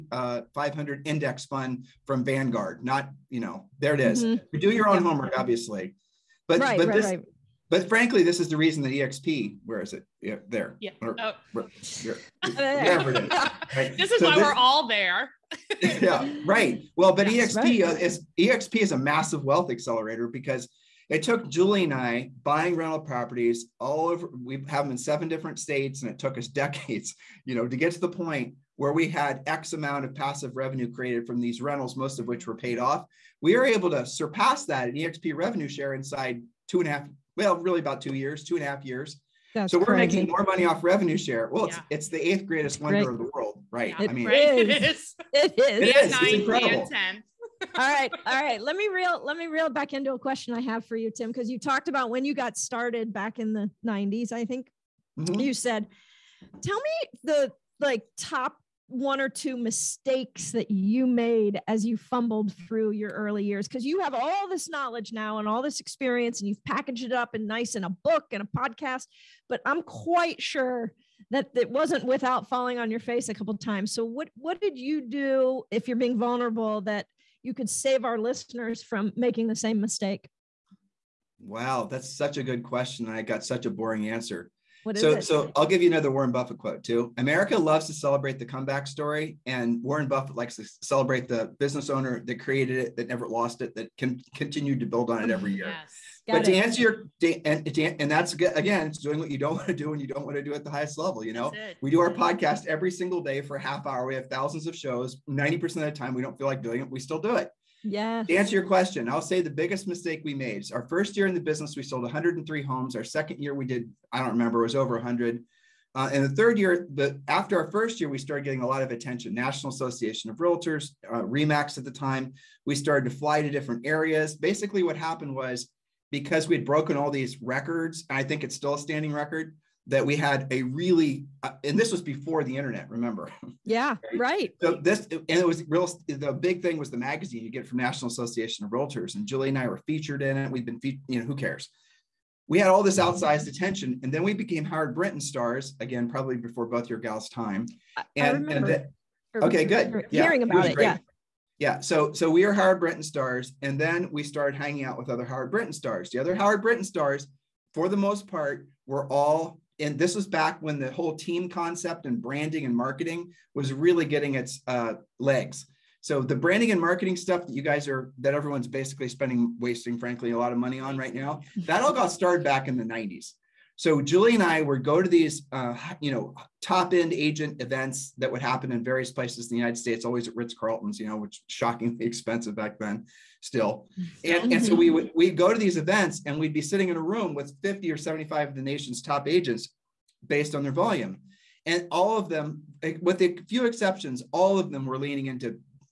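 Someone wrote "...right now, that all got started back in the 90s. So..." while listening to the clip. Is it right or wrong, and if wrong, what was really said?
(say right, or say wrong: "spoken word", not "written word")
right.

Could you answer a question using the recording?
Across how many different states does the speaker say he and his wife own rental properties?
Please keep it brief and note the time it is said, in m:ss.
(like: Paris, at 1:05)
7, at 0:24.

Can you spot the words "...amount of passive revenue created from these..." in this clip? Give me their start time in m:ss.
0:29.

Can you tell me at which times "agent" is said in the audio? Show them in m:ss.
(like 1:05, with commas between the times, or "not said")
2:57, 3:09.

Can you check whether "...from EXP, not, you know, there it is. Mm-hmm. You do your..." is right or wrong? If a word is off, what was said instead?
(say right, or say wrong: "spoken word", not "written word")
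wrong: "Vanguard", not "EXP".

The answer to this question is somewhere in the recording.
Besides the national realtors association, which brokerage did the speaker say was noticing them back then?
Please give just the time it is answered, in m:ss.
2:01.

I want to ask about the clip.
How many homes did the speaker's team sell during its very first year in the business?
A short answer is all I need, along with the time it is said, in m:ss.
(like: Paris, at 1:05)
103, at 1:52.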